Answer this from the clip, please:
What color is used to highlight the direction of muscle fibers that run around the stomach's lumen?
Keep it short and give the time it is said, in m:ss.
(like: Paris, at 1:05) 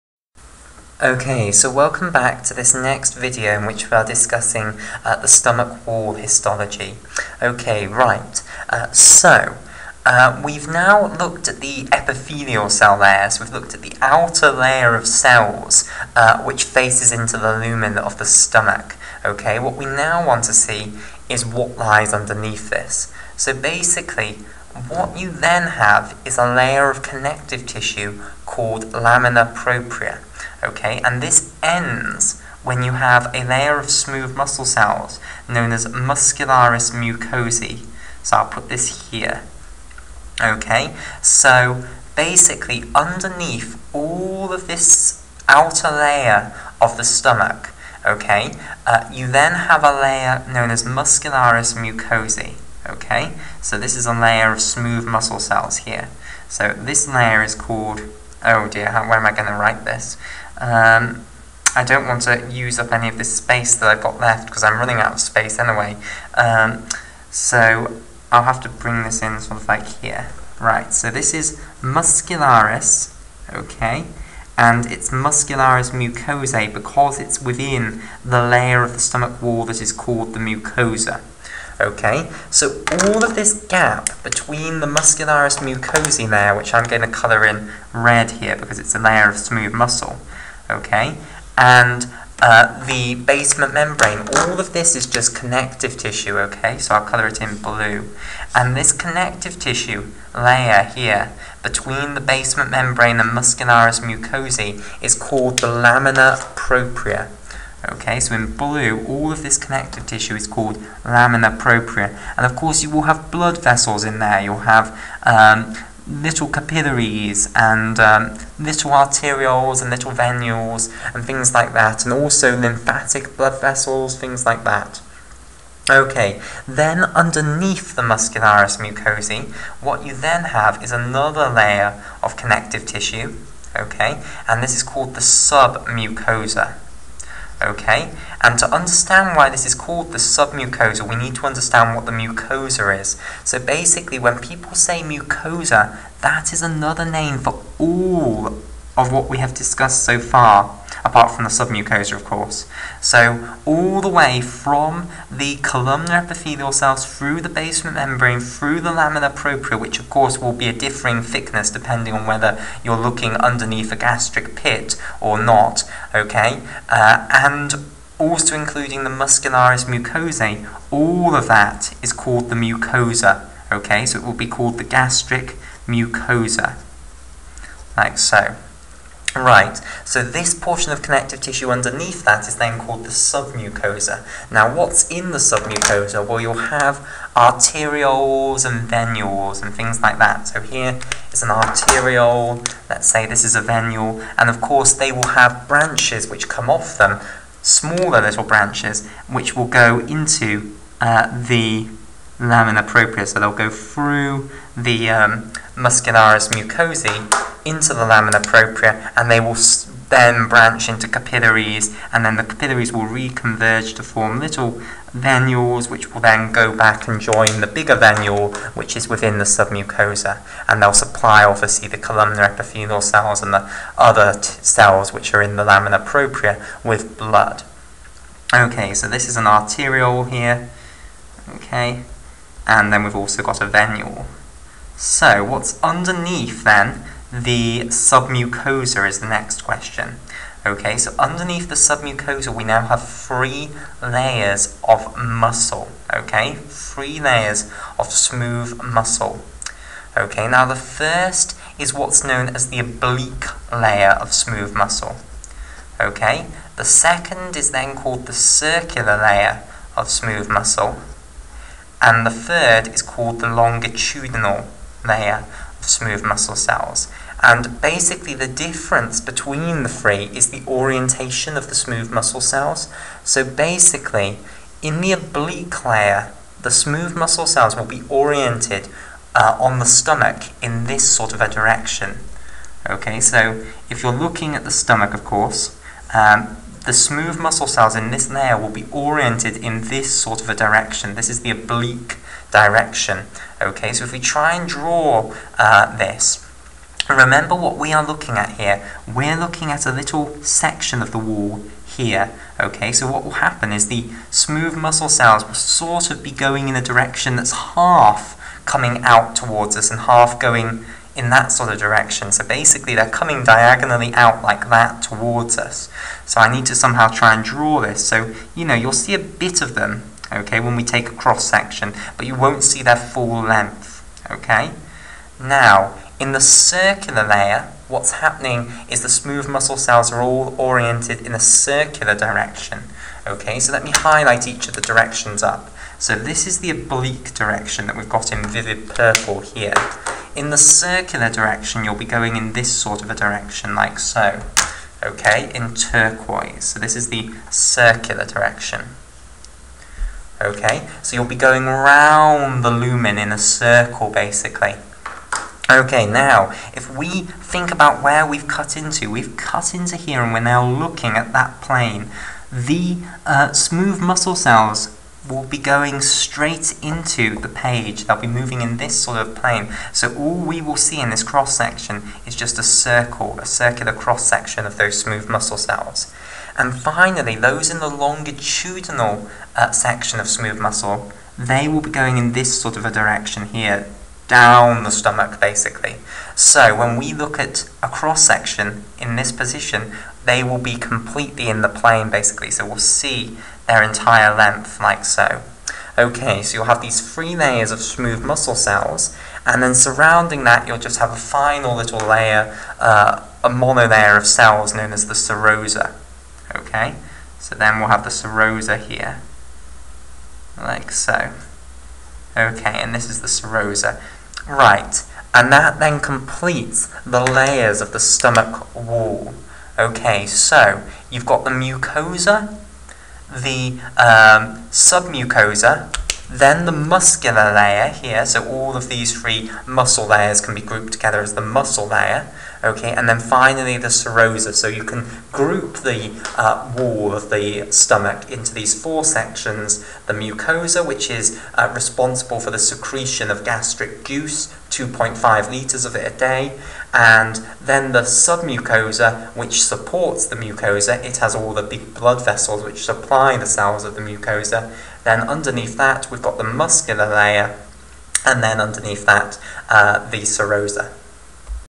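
turquoise, at 5:45.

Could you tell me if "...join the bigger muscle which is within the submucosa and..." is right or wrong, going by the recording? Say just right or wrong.
wrong.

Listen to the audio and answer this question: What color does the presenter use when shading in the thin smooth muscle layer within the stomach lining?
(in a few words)
red.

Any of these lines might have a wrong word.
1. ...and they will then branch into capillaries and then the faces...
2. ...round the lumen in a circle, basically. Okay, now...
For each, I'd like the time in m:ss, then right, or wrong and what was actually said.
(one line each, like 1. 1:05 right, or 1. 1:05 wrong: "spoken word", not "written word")
1. 3:29 wrong: "capillaries", not "faces"
2. 5:51 right.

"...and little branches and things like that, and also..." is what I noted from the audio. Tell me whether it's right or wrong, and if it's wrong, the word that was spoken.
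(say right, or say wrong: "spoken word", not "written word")
wrong: "venules", not "branches".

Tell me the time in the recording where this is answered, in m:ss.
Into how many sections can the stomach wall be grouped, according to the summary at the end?
7:18.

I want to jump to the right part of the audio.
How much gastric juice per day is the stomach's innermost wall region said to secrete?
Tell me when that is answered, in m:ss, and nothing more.
7:24.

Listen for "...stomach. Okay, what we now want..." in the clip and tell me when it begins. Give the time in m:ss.
0:18.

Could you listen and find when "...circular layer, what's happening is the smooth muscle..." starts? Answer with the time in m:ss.
5:26.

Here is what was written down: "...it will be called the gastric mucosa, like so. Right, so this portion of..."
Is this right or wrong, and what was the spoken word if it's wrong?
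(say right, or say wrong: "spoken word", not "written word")
right.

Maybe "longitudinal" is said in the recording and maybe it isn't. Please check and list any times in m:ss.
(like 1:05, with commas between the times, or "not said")
4:23, 6:17.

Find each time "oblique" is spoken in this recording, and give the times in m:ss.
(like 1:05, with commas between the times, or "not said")
4:12, 4:35, 4:51, 5:36.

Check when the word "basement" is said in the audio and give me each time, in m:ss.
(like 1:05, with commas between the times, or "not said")
1:33, 1:42, 2:37.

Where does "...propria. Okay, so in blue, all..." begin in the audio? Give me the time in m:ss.
1:46.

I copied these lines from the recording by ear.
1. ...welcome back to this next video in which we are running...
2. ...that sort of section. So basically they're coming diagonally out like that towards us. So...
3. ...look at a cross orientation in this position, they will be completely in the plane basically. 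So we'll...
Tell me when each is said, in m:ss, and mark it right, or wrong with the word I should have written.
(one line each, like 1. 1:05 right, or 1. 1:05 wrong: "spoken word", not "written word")
1. 0:01 wrong: "discussing", not "running"
2. 5:11 wrong: "direction", not "section"
3. 6:27 wrong: "section", not "orientation".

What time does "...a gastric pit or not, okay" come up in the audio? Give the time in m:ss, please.
2:43.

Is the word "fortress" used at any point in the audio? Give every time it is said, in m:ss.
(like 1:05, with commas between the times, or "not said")
not said.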